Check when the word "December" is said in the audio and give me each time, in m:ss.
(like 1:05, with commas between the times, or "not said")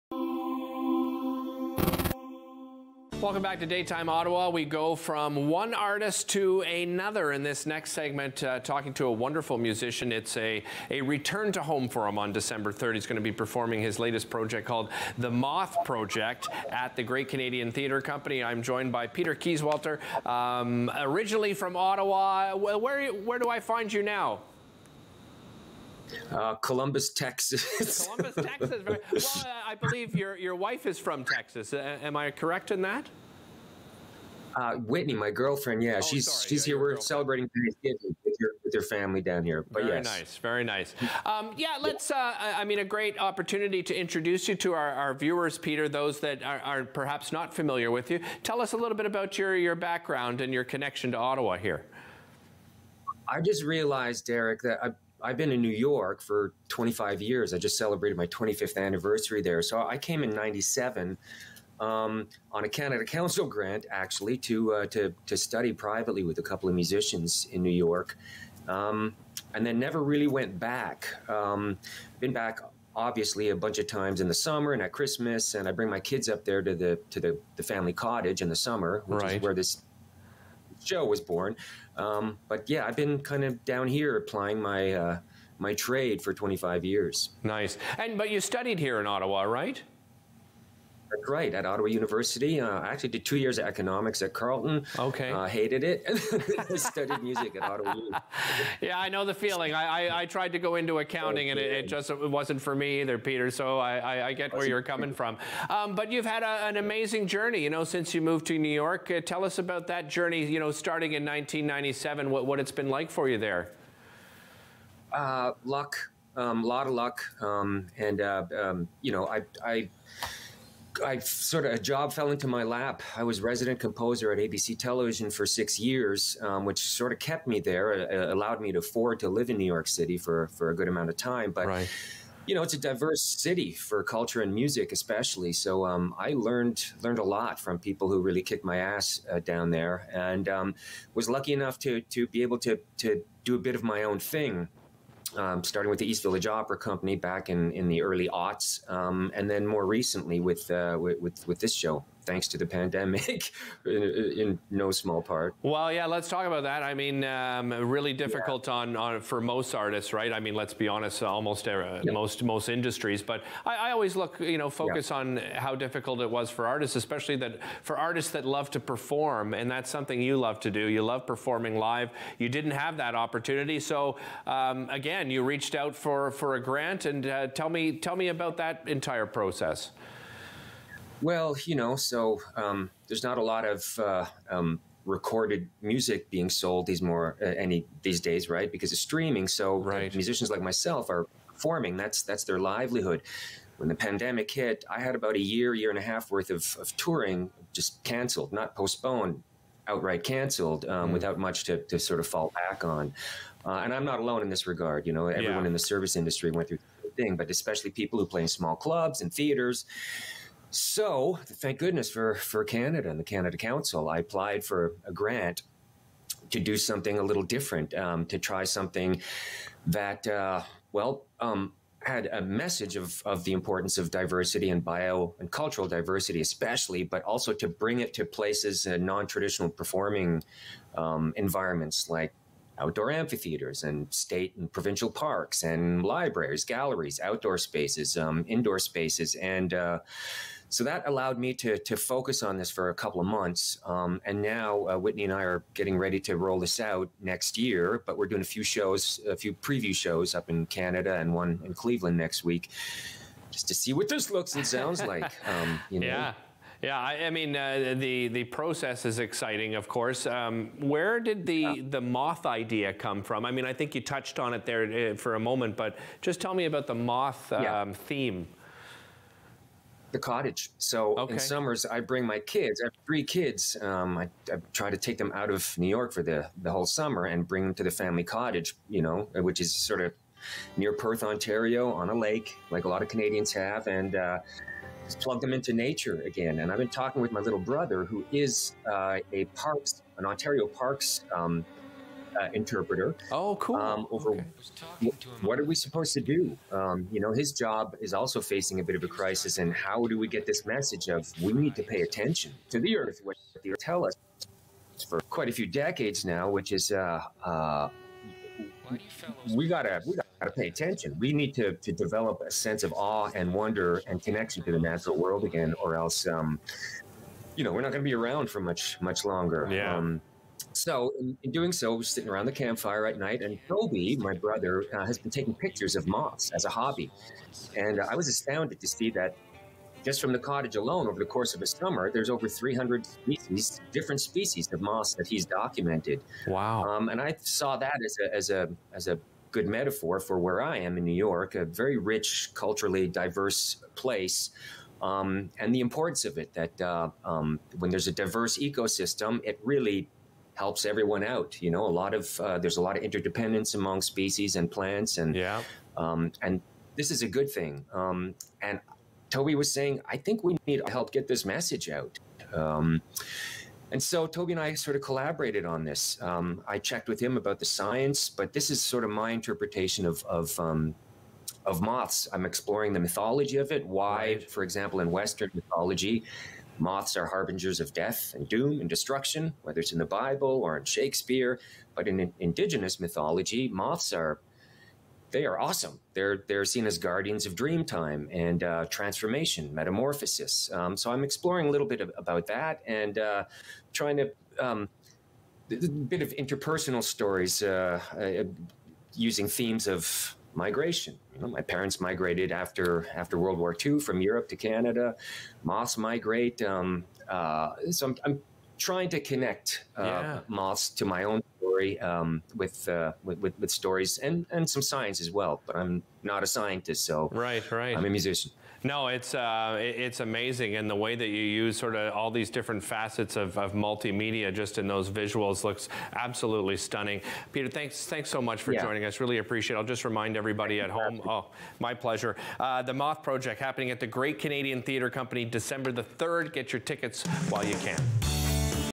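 0:12, 7:15.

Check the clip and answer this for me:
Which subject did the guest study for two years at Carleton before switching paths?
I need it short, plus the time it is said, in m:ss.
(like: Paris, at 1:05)
economics, at 1:33.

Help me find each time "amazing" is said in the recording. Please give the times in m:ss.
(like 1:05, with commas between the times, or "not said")
1:46, 7:00.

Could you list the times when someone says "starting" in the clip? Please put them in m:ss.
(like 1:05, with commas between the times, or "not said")
1:50, 2:25.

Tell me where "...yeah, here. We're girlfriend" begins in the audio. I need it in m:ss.
0:36.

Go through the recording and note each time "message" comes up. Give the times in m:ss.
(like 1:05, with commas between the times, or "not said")
3:42, 5:00, 6:01.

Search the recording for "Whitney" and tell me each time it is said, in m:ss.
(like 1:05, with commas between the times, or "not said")
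0:34, 4:04.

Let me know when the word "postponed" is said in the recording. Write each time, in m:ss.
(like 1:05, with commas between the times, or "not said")
3:18.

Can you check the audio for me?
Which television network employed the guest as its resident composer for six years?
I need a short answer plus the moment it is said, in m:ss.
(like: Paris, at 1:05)
ABC, at 2:04.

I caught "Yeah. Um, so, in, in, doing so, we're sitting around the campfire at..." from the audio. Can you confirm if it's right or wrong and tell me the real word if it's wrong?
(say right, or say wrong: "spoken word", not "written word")
right.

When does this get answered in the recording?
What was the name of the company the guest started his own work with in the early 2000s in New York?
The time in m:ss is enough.
2:26.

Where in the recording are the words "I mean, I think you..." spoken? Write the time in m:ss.
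4:23.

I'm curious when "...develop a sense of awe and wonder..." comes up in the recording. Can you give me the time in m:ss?
5:11.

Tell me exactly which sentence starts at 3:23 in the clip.
Uh, and I'm not alone in this regard.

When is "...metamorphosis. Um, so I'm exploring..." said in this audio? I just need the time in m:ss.
6:29.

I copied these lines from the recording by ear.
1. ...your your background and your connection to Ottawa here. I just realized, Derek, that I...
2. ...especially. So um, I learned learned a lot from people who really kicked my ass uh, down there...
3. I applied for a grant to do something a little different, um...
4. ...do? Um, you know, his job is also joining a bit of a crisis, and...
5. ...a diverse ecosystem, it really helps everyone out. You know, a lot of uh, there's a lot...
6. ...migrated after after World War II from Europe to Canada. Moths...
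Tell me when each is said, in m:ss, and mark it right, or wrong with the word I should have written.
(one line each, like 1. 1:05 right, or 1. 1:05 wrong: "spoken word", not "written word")
1. 0:49 right
2. 2:14 right
3. 3:34 right
4. 4:56 wrong: "facing", not "joining"
5. 5:48 right
6. 6:42 right.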